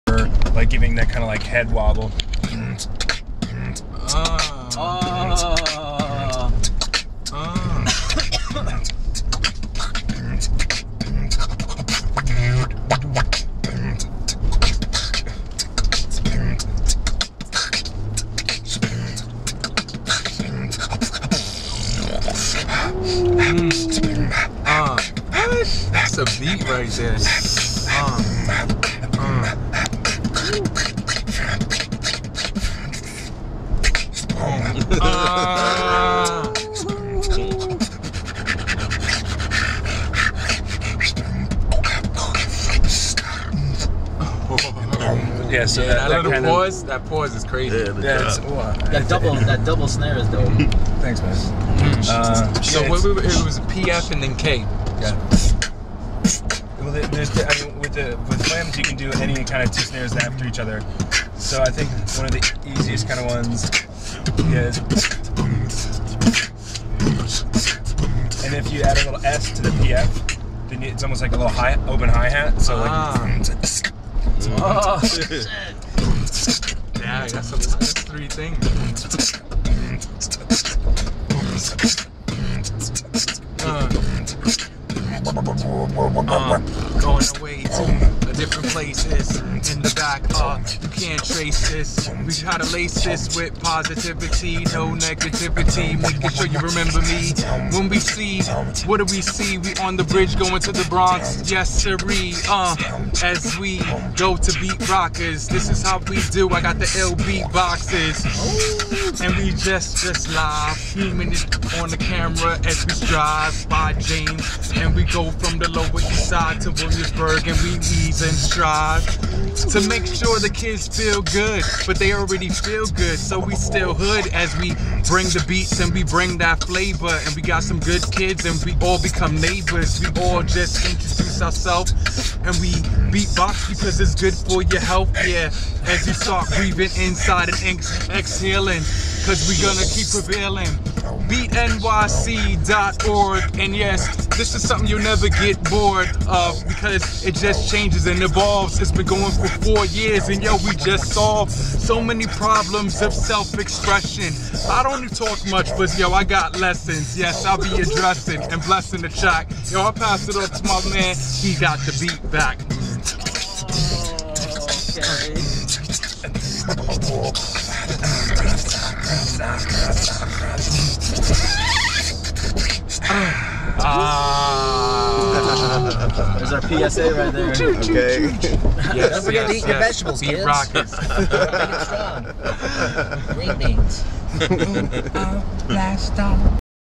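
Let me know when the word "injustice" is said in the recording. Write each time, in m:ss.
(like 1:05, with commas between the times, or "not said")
not said.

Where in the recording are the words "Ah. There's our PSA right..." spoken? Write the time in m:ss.
2:53.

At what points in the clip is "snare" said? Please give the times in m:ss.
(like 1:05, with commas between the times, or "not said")
0:49, 0:59.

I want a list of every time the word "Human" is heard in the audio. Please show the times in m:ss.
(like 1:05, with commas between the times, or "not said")
1:50.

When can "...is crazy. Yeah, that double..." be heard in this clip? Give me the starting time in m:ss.
0:47.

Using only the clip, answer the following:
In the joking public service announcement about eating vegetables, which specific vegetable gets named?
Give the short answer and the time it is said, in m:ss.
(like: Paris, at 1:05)
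Green beans, at 3:05.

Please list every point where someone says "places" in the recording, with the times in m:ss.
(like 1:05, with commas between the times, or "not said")
1:28.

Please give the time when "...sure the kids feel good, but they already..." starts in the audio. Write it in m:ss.
2:00.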